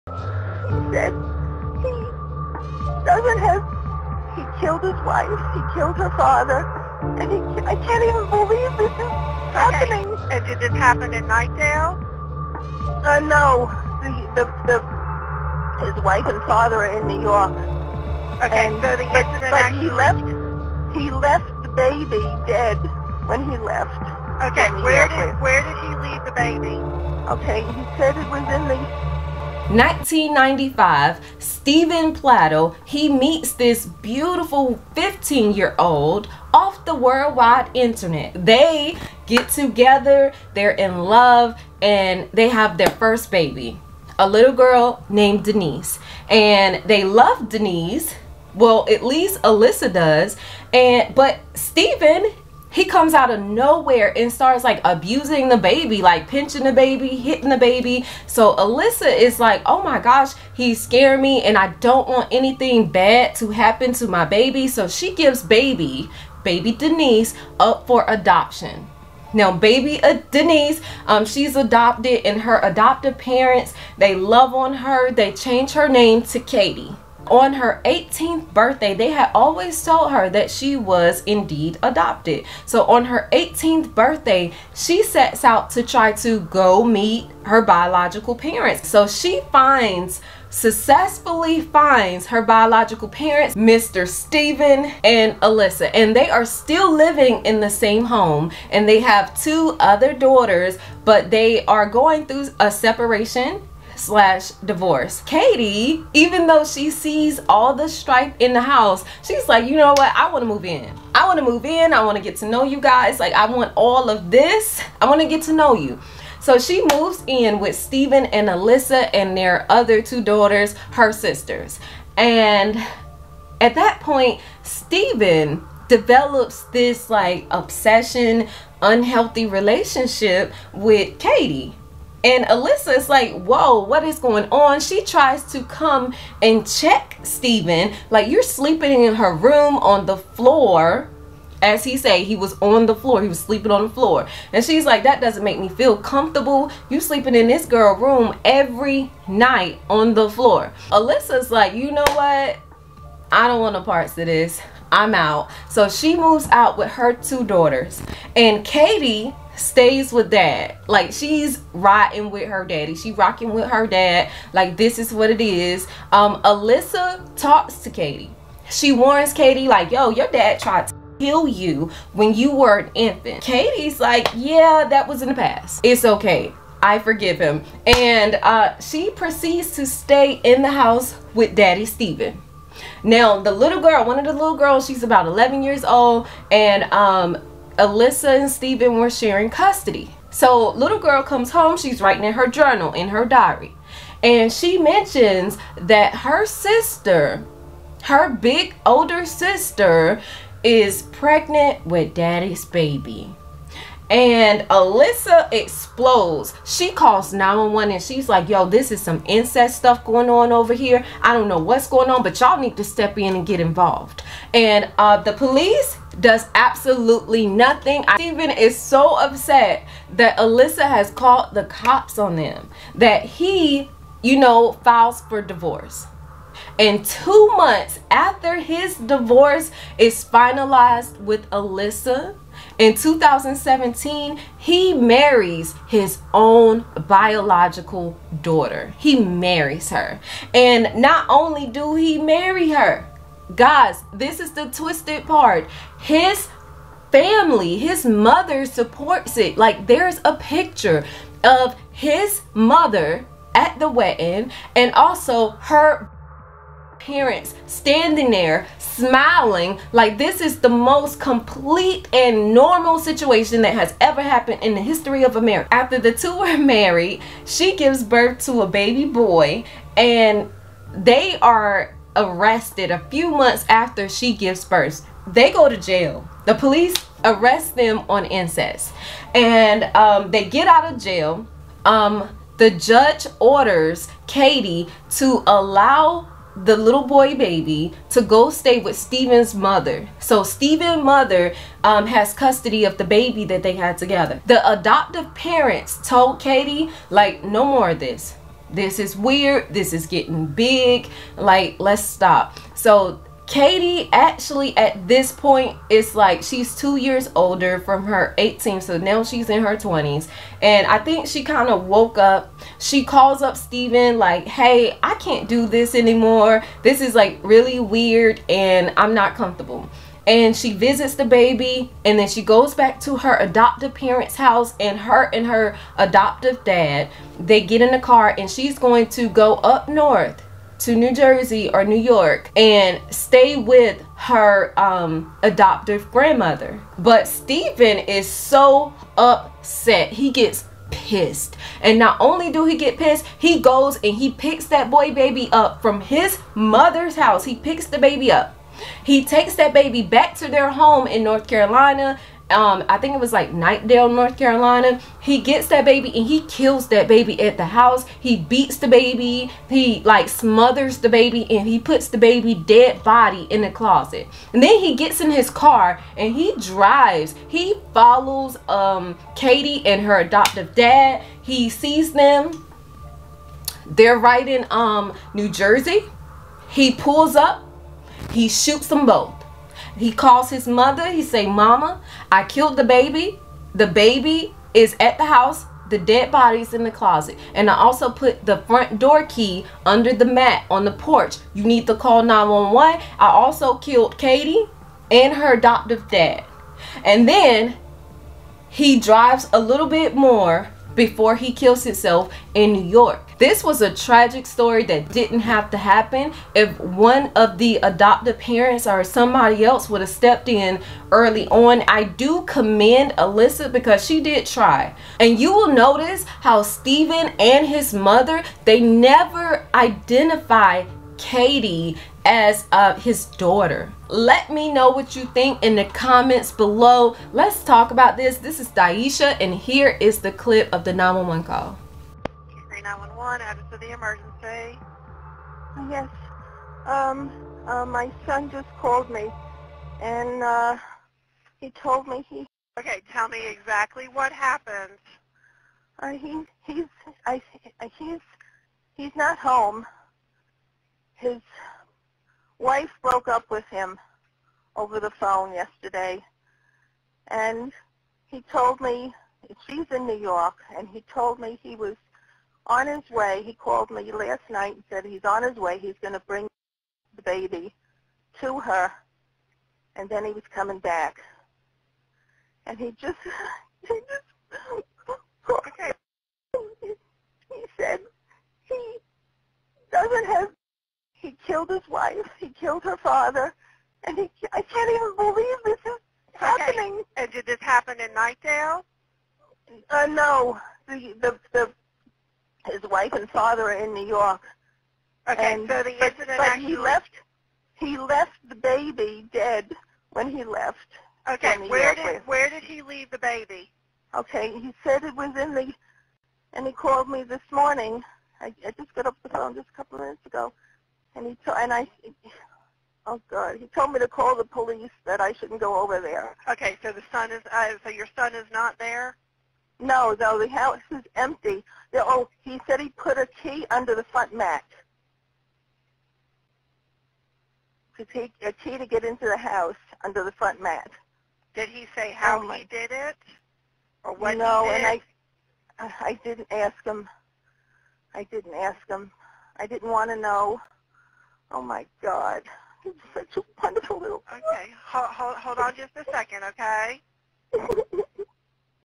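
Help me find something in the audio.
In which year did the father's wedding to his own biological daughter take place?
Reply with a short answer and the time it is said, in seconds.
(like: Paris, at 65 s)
2017, at 232 s.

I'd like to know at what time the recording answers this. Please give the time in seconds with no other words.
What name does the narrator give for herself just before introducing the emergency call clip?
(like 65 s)
428 s.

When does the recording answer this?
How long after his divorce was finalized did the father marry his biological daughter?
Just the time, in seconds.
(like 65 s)
227 s.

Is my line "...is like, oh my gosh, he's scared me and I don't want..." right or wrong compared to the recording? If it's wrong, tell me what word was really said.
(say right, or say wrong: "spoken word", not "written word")
right.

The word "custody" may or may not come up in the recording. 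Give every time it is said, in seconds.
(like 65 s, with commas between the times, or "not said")
189 s, 292 s.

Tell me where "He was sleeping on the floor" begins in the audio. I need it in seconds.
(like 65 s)
143 s.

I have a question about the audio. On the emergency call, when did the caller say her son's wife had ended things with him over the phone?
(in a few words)
Yesterday.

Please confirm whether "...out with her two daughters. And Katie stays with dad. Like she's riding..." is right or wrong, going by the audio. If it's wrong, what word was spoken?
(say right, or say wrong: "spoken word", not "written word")
right.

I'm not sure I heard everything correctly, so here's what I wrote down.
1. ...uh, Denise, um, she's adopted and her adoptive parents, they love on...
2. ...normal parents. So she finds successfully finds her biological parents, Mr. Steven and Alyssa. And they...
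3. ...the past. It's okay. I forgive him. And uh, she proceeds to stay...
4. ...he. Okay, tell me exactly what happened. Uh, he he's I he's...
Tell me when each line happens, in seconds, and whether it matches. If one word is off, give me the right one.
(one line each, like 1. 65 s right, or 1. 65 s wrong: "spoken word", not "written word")
1. 70 s right
2. 87 s wrong: "biological", not "normal"
3. 175 s right
4. 442 s right.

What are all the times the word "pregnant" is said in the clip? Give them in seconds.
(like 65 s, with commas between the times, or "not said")
201 s.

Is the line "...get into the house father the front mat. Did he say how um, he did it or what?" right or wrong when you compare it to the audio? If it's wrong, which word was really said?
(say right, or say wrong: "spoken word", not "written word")
wrong: "under", not "father".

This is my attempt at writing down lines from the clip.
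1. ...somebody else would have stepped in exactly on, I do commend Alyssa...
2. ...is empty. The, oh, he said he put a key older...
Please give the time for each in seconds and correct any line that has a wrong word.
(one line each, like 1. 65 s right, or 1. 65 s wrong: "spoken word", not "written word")
1. 409 s wrong: "early", not "exactly"
2. 520 s wrong: "under", not "older".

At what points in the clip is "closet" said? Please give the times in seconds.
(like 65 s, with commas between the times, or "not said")
363 s, 386 s.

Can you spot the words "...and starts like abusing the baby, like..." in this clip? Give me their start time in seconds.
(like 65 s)
54 s.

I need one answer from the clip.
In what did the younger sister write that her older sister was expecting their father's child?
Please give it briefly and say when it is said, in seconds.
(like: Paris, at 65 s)
Her diary, at 193 s.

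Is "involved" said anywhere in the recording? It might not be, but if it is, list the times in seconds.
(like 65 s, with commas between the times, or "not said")
213 s.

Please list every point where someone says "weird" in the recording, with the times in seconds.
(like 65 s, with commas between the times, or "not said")
299 s, 317 s.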